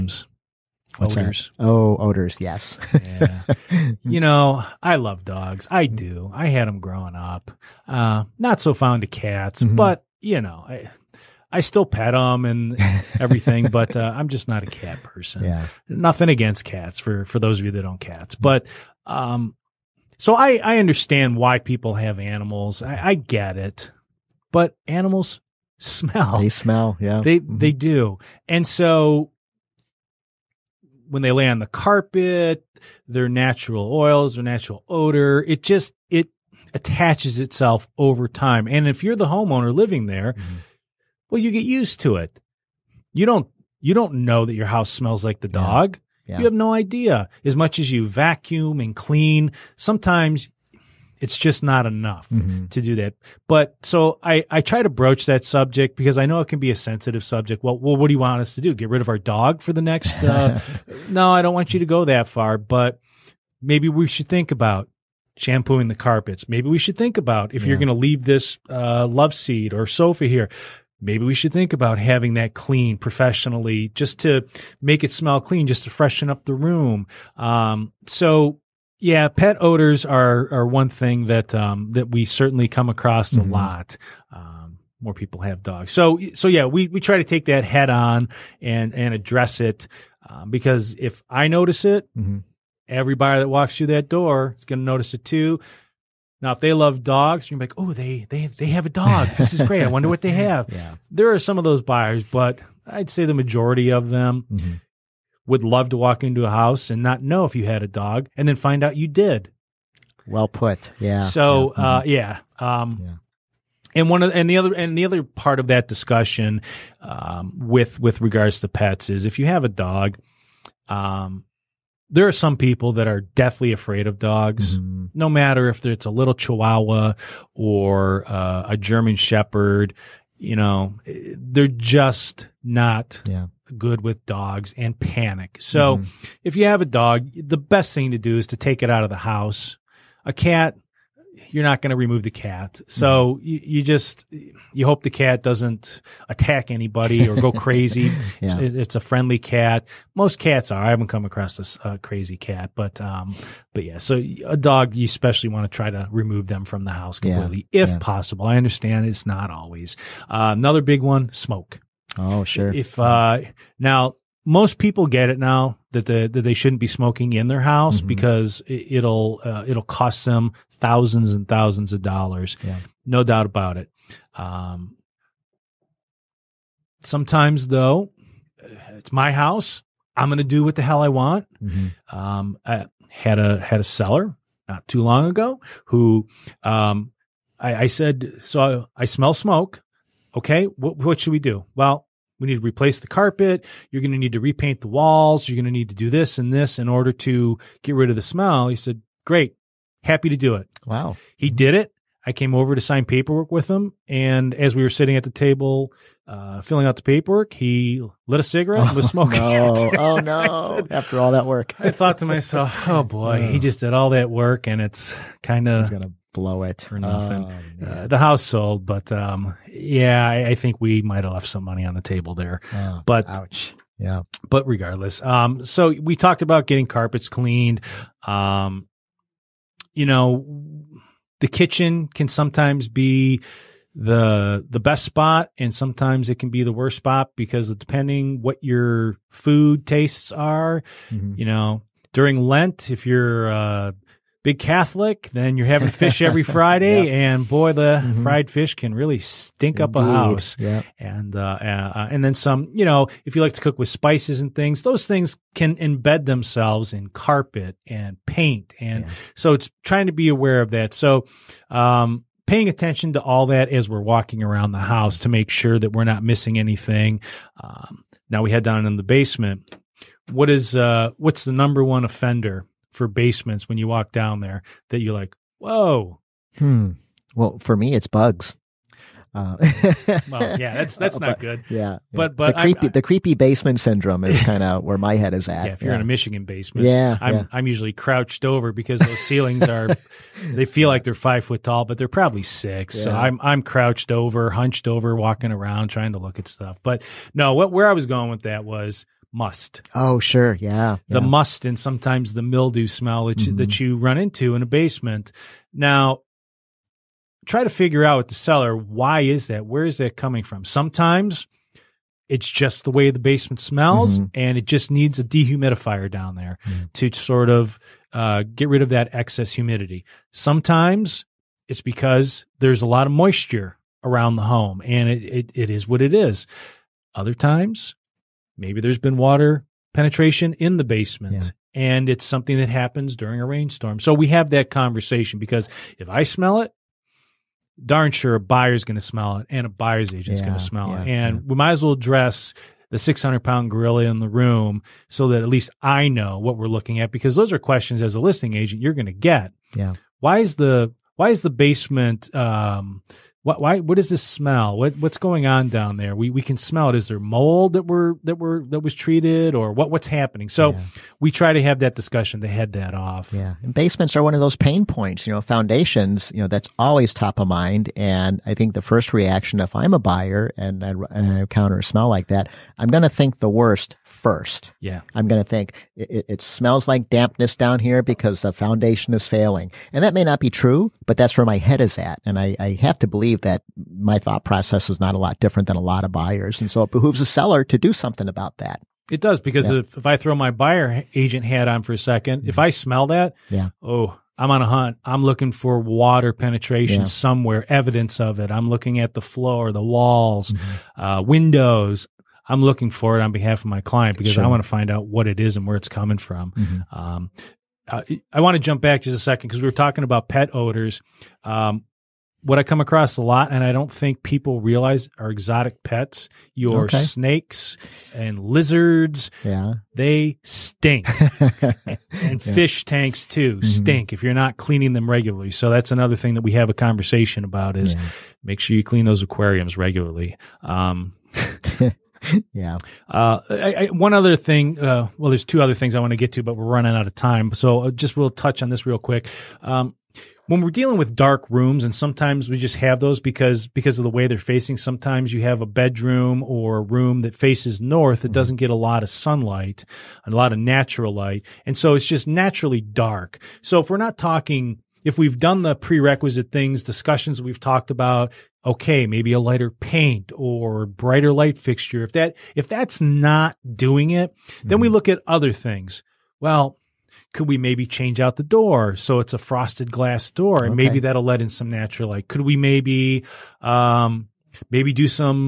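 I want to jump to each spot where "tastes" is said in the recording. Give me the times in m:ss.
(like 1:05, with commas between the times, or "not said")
3:59.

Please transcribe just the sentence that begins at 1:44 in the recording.
Mm-hmm would love to walk into a house and not know if you had a dog and then find out you did.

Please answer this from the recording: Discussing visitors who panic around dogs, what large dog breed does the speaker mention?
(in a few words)
German Shepherd.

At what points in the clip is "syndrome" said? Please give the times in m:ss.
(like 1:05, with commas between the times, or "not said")
4:43.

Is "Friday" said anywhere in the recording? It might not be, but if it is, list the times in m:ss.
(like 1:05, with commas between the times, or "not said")
4:06.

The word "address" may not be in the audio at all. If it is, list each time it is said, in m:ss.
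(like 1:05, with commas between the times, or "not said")
1:29, 5:41.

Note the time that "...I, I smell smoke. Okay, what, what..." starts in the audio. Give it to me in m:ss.
3:08.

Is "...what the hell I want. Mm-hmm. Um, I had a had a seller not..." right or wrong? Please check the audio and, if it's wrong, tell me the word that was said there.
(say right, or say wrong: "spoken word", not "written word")
right.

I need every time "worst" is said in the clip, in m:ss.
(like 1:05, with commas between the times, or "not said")
3:56, 6:13.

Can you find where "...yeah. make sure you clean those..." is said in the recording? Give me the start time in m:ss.
7:07.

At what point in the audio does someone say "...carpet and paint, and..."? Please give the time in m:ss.
4:17.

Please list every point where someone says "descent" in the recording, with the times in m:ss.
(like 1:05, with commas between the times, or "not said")
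not said.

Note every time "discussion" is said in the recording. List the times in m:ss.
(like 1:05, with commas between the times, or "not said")
1:55, 6:01, 7:36.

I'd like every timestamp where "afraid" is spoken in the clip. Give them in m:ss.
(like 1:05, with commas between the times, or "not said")
2:03.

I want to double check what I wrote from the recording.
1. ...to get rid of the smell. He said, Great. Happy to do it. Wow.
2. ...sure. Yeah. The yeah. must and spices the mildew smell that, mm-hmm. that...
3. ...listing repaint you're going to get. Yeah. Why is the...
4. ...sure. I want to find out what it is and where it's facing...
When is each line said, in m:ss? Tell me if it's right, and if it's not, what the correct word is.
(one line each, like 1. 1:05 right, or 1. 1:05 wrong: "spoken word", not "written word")
1. 3:17 right
2. 5:00 wrong: "sometimes", not "spices"
3. 5:48 wrong: "agent", not "repaint"
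4. 6:44 wrong: "coming", not "facing".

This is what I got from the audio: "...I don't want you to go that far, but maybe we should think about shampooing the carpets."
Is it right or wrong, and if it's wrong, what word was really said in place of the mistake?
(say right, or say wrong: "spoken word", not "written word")
right.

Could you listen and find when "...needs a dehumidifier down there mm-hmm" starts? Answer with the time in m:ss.
5:14.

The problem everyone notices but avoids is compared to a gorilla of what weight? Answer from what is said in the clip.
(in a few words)
600 pounds.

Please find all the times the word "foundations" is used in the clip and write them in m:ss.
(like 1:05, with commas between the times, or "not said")
6:05, 6:18.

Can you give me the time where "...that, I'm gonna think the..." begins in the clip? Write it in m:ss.
6:12.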